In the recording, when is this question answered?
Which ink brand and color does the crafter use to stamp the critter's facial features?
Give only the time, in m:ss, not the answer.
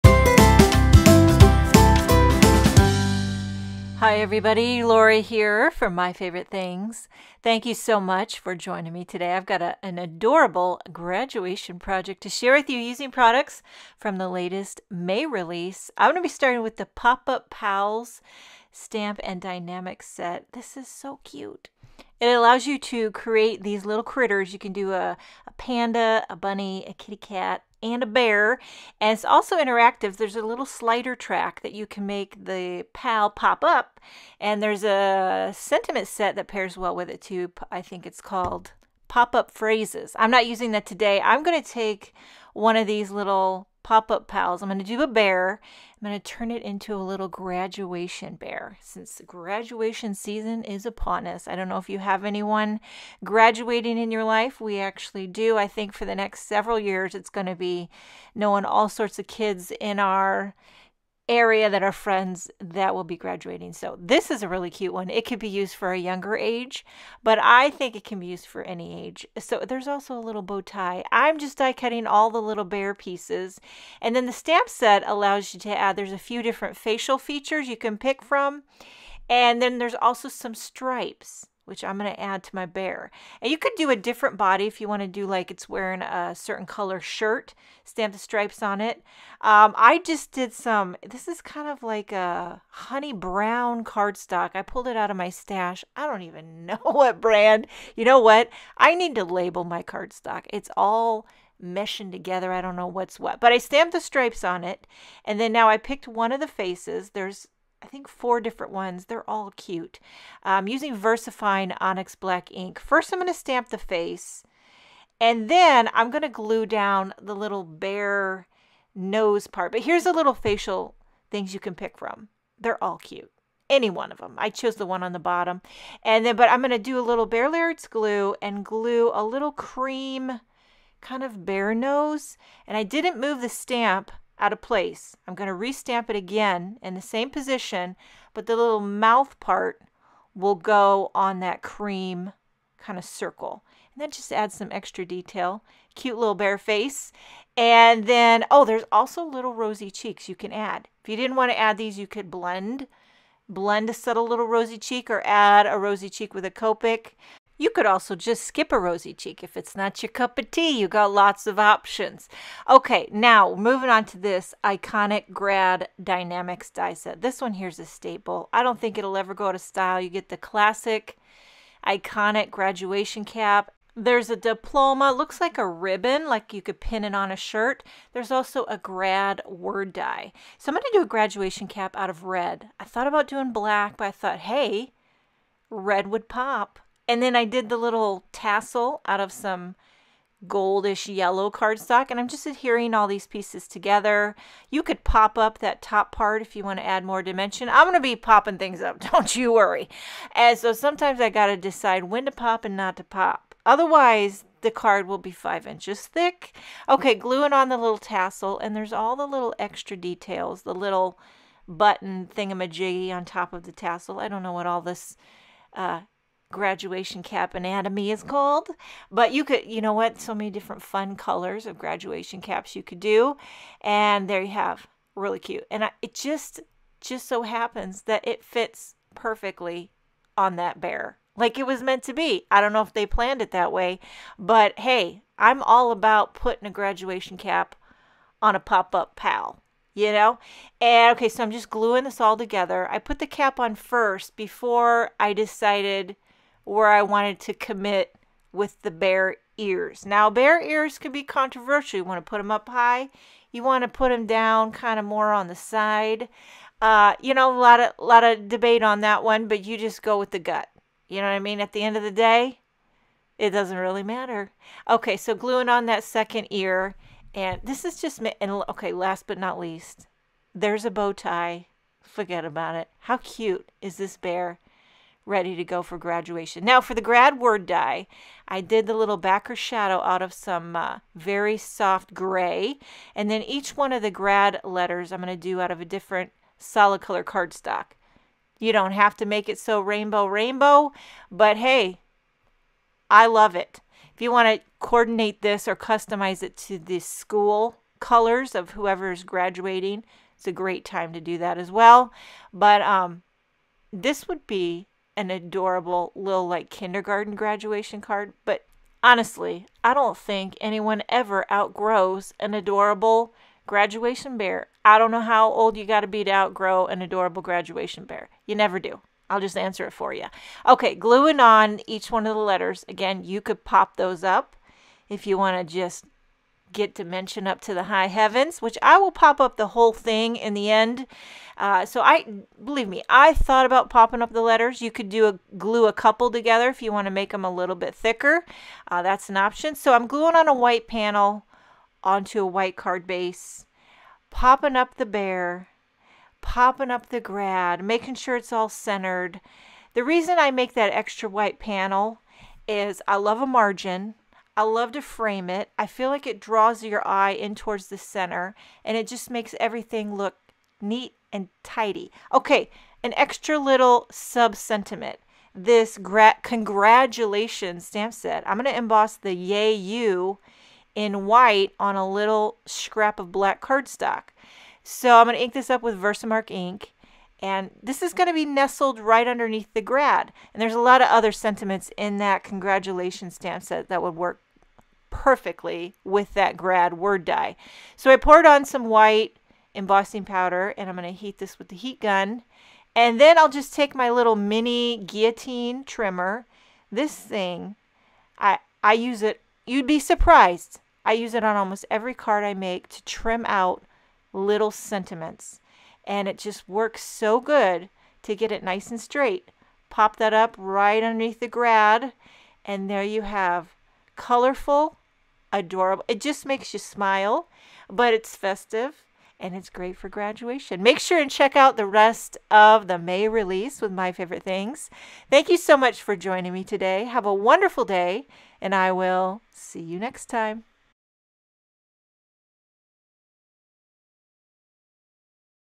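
1:50.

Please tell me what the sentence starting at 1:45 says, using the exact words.
And then now I picked one of the faces.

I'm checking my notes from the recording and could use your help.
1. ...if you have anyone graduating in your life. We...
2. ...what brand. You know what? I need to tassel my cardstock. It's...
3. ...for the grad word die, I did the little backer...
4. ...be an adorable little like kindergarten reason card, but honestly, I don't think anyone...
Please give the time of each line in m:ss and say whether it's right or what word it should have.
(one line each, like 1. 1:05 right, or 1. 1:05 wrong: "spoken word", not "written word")
1. 0:51 right
2. 1:36 wrong: "label", not "tassel"
3. 4:36 right
4. 5:04 wrong: "graduation", not "reason".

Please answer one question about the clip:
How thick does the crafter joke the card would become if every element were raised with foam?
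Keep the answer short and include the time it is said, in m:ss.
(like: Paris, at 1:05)
5 inches, at 3:25.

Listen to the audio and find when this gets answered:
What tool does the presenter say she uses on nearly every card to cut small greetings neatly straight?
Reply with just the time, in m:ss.
6:34.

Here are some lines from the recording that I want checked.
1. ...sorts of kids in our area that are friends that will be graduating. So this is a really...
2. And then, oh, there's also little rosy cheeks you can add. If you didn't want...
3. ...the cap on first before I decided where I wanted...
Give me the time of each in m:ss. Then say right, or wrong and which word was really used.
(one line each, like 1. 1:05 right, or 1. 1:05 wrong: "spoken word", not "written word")
1. 0:58 right
2. 2:27 right
3. 4:03 right.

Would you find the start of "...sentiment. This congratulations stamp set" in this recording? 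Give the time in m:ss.
6:04.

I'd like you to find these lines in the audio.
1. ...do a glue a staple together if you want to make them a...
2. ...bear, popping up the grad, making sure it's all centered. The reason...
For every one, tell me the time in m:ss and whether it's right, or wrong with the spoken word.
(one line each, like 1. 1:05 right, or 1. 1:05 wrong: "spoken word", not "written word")
1. 5:35 wrong: "couple", not "staple"
2. 5:45 right.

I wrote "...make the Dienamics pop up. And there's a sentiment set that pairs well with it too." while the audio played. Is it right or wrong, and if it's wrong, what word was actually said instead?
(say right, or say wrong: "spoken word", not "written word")
wrong: "PAL", not "Dienamics".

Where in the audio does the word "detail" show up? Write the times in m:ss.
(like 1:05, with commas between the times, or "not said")
2:25, 3:29.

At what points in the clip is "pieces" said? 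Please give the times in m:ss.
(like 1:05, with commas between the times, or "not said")
1:12, 3:13.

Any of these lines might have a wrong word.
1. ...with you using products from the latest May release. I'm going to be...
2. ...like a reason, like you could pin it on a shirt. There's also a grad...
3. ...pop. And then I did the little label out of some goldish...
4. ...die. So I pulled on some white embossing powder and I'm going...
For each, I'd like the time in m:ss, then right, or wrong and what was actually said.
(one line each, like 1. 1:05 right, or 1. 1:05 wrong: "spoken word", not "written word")
1. 0:12 right
2. 2:55 wrong: "ribbon", not "reason"
3. 3:06 wrong: "tassel", not "label"
4. 6:27 wrong: "poured", not "pulled".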